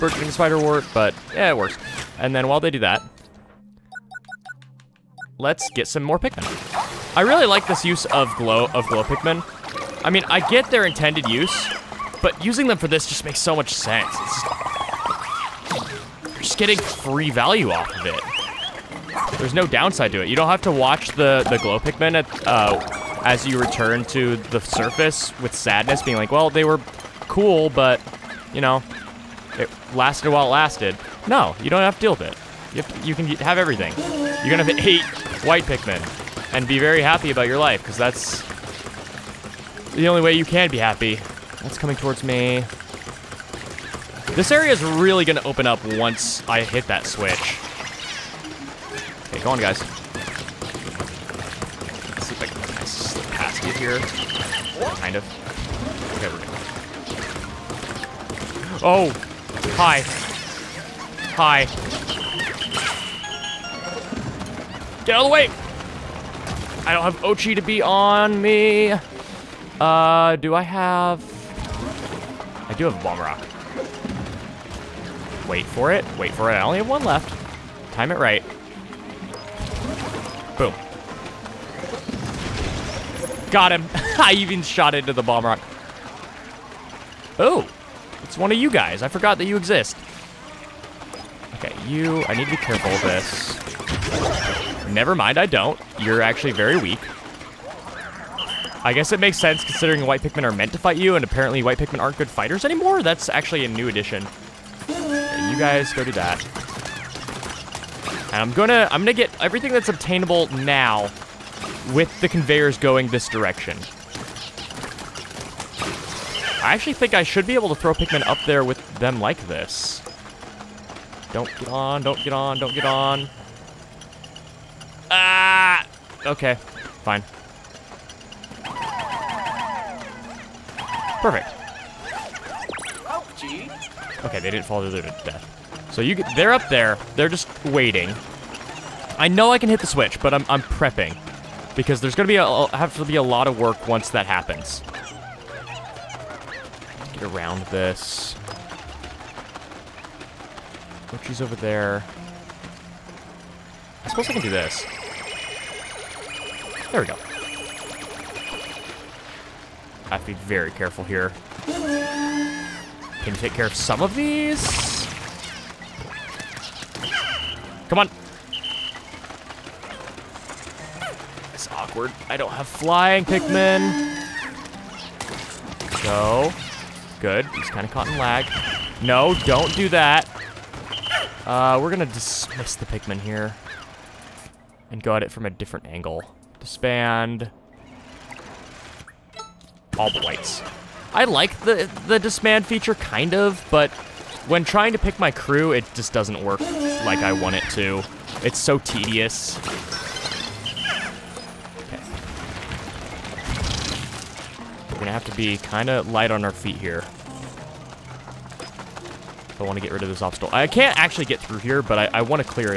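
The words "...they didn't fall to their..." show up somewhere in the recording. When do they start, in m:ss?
2:14.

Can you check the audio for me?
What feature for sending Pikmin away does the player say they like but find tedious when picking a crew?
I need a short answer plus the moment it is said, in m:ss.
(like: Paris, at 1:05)
disband feature, at 3:12.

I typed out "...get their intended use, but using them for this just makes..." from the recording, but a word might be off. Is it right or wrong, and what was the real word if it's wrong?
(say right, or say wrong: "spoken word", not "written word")
right.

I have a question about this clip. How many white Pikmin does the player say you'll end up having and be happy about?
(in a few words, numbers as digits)
8.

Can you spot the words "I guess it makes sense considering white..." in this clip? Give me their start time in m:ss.
1:38.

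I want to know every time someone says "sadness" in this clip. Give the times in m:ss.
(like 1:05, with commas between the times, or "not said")
0:25.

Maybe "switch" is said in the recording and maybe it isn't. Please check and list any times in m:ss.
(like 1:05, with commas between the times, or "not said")
0:47, 2:19.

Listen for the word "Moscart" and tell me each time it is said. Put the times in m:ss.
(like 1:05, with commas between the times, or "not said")
not said.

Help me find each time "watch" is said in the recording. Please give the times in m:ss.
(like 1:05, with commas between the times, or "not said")
0:20.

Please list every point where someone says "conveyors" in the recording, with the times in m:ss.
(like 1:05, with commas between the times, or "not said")
1:52.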